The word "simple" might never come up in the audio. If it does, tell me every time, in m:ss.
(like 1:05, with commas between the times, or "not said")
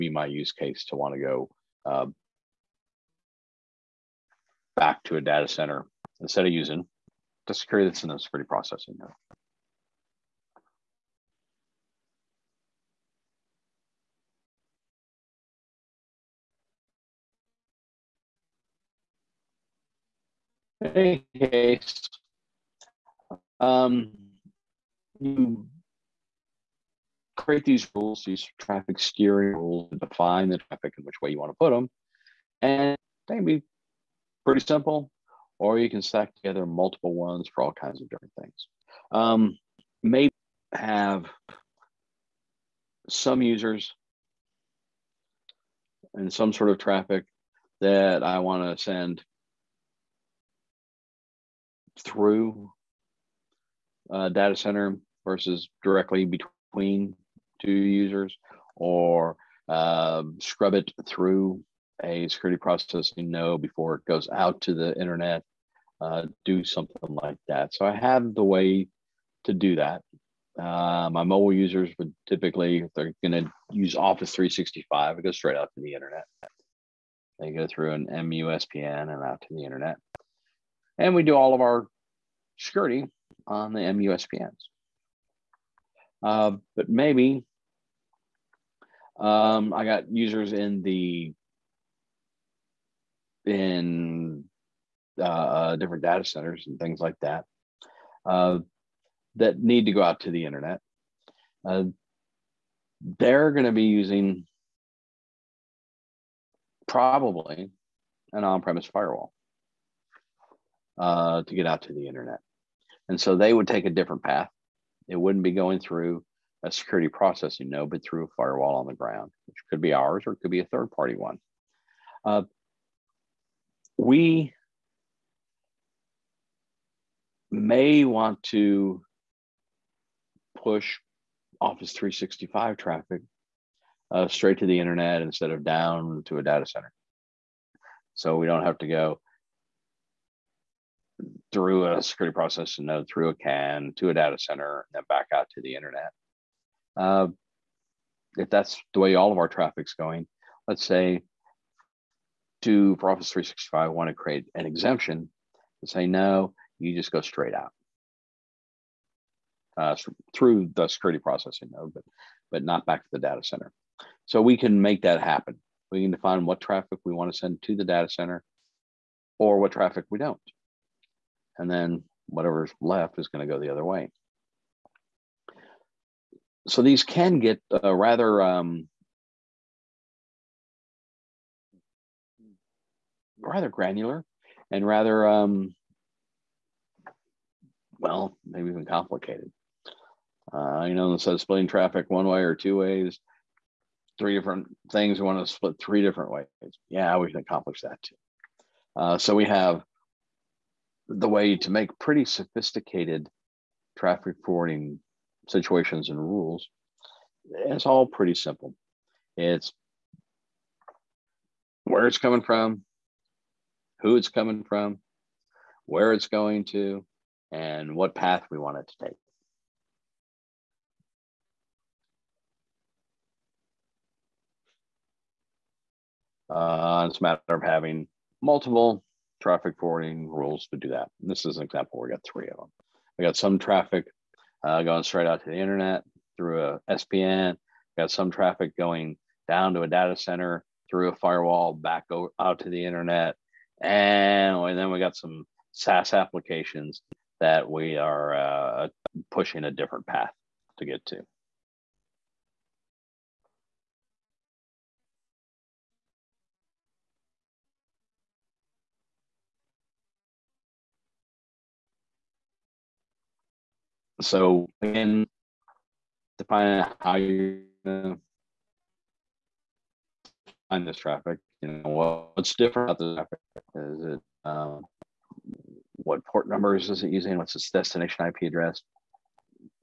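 0:34, 3:28.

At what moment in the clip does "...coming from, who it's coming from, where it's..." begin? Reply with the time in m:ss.
3:32.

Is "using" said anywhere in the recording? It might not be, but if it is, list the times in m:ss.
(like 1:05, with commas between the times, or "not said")
0:06, 1:43, 4:37.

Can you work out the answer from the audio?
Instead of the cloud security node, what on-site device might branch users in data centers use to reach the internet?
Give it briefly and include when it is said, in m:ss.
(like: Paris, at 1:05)
On-premise firewall, at 1:48.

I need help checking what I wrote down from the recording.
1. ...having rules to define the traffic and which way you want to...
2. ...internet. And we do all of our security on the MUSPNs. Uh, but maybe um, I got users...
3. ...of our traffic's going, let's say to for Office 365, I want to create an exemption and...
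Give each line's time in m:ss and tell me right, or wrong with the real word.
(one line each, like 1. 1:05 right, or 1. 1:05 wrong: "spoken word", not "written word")
1. 0:28 wrong: "steering", not "having"
2. 1:19 right
3. 2:29 right.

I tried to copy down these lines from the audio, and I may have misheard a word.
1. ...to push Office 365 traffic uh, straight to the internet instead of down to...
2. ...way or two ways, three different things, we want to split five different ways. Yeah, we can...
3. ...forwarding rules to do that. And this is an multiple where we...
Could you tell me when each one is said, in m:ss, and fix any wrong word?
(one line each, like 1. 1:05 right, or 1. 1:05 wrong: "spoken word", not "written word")
1. 2:08 right
2. 3:12 wrong: "three", not "five"
3. 3:49 wrong: "example", not "multiple".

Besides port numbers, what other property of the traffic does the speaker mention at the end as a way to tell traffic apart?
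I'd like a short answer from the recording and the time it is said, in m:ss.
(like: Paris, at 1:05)
Destination IP address, at 4:37.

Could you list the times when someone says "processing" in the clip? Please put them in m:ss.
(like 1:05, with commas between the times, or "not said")
0:08, 1:02, 1:57, 2:22, 2:41.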